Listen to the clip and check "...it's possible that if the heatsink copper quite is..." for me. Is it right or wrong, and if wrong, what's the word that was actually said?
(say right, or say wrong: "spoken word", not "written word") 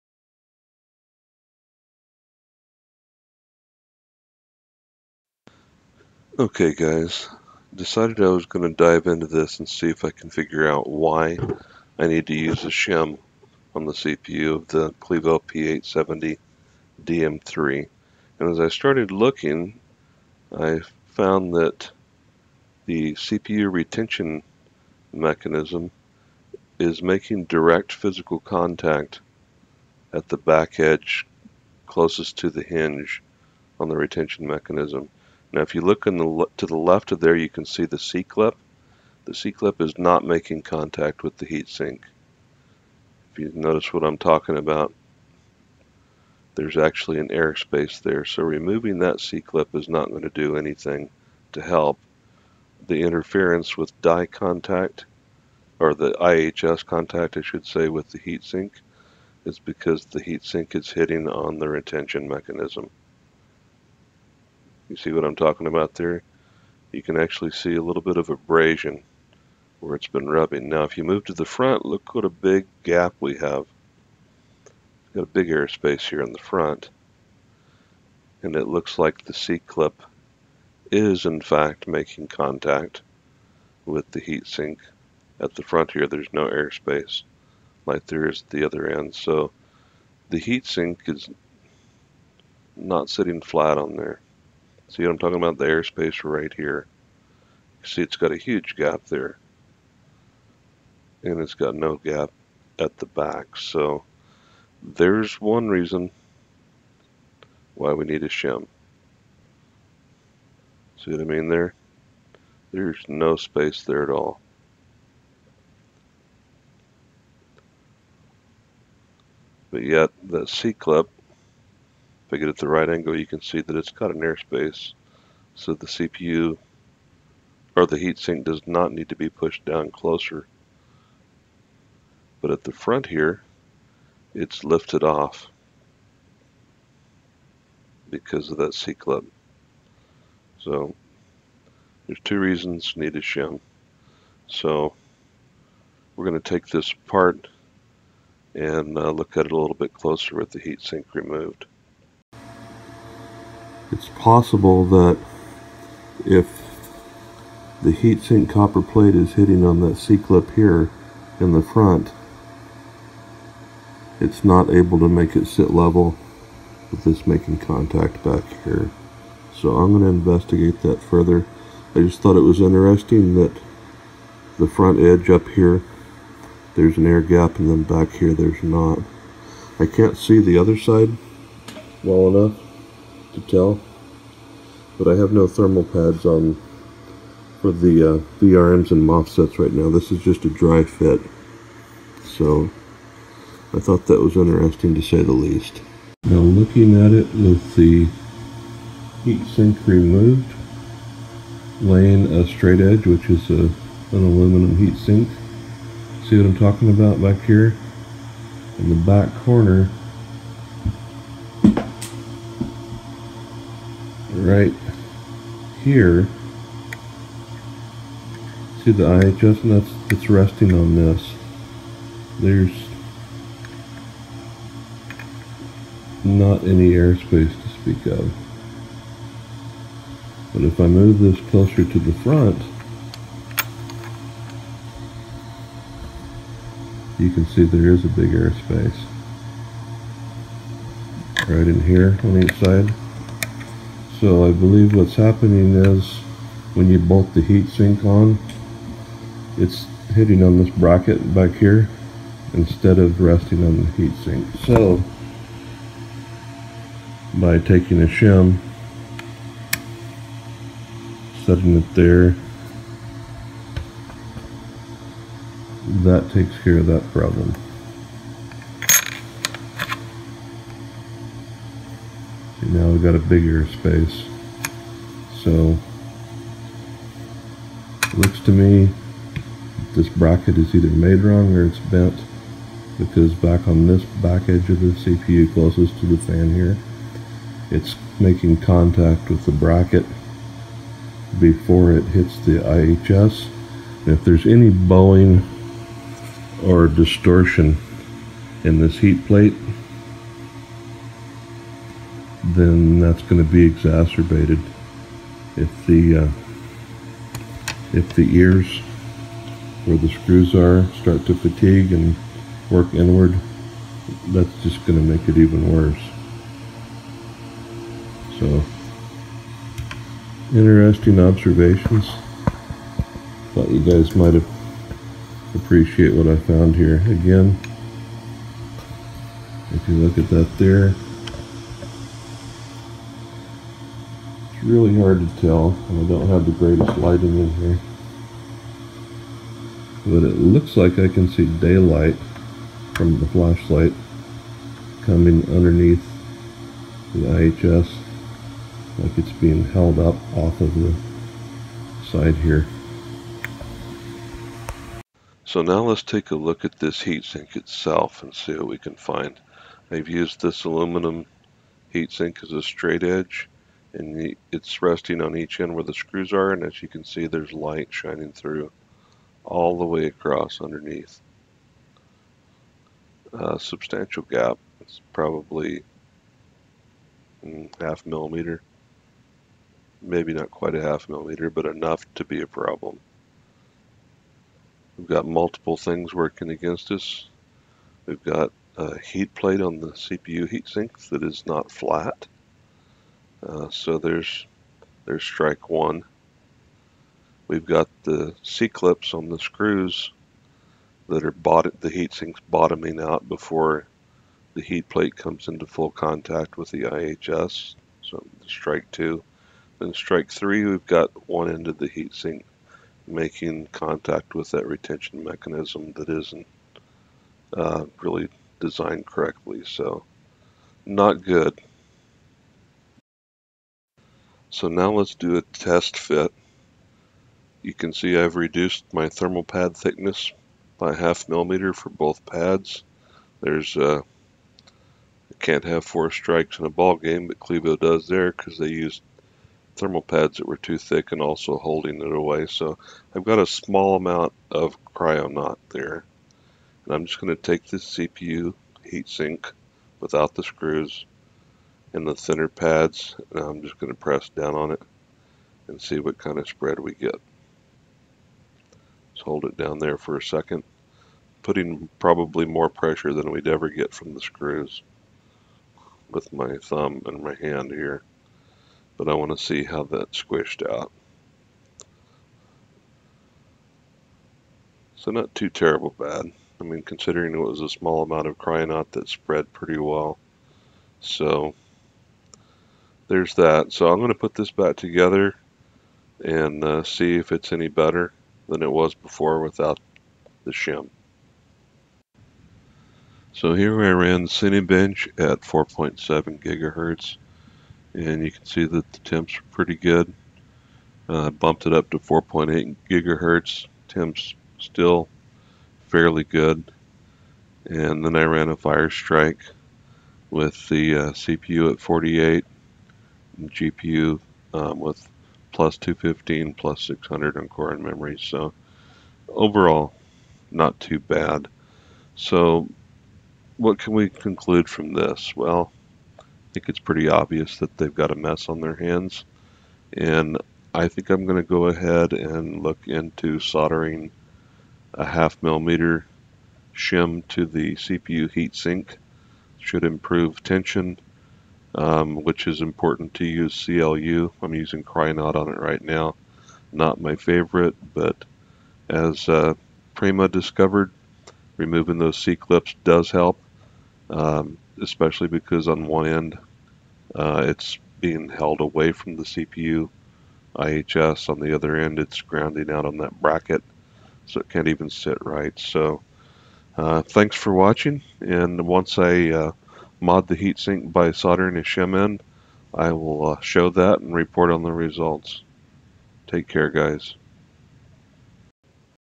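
wrong: "plate", not "quite".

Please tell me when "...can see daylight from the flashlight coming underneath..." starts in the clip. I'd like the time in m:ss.
5:41.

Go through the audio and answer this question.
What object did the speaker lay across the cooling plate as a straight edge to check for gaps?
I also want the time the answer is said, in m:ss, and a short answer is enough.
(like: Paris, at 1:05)
aluminum heat sink, at 3:24.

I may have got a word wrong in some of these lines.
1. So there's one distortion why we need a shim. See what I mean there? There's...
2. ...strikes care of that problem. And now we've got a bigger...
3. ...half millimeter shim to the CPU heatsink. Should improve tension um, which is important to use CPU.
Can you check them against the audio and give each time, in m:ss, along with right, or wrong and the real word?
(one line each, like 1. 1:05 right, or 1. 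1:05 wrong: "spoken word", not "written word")
1. 1:43 wrong: "reason", not "distortion"
2. 4:26 wrong: "takes", not "strikes"
3. 8:55 wrong: "CLU", not "CPU".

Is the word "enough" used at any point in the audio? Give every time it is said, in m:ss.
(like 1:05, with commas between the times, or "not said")
3:02, 6:21.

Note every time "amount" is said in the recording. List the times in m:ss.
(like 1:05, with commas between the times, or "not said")
7:23, 7:58.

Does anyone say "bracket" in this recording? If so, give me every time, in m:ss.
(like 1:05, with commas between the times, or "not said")
4:10, 4:40, 4:49, 9:23.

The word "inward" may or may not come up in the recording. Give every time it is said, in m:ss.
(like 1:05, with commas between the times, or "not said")
5:12.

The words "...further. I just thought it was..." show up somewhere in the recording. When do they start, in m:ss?
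2:51.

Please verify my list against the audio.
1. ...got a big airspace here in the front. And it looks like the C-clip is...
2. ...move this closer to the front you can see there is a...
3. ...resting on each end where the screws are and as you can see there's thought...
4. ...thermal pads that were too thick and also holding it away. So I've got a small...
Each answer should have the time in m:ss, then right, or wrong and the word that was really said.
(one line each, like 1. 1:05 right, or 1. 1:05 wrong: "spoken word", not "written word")
1. 1:15 right
2. 3:50 right
3. 6:04 wrong: "light", not "thought"
4. 7:19 right.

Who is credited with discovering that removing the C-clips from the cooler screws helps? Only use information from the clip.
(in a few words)
Prema.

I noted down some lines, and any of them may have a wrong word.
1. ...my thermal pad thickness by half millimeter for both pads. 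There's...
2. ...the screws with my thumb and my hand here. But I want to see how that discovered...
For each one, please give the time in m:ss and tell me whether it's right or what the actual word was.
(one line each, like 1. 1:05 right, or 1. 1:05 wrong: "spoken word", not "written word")
1. 7:08 right
2. 7:44 wrong: "squished", not "discovered".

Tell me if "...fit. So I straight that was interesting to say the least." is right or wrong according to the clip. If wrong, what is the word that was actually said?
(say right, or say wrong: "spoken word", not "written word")
wrong: "thought", not "straight".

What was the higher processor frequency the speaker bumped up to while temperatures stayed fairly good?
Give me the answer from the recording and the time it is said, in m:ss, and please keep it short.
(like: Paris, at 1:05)
4.8 gigahertz, at 8:21.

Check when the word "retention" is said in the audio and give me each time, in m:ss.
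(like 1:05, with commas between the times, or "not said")
0:23, 0:33, 1:01, 6:54.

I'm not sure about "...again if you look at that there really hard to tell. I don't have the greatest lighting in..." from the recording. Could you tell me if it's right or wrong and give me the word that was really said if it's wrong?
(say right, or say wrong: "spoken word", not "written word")
right.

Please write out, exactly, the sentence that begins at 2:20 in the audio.
So there's two reasons needed shim.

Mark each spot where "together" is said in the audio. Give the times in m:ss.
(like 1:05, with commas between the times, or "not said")
8:04.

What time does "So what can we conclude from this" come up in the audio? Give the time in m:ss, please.
8:42.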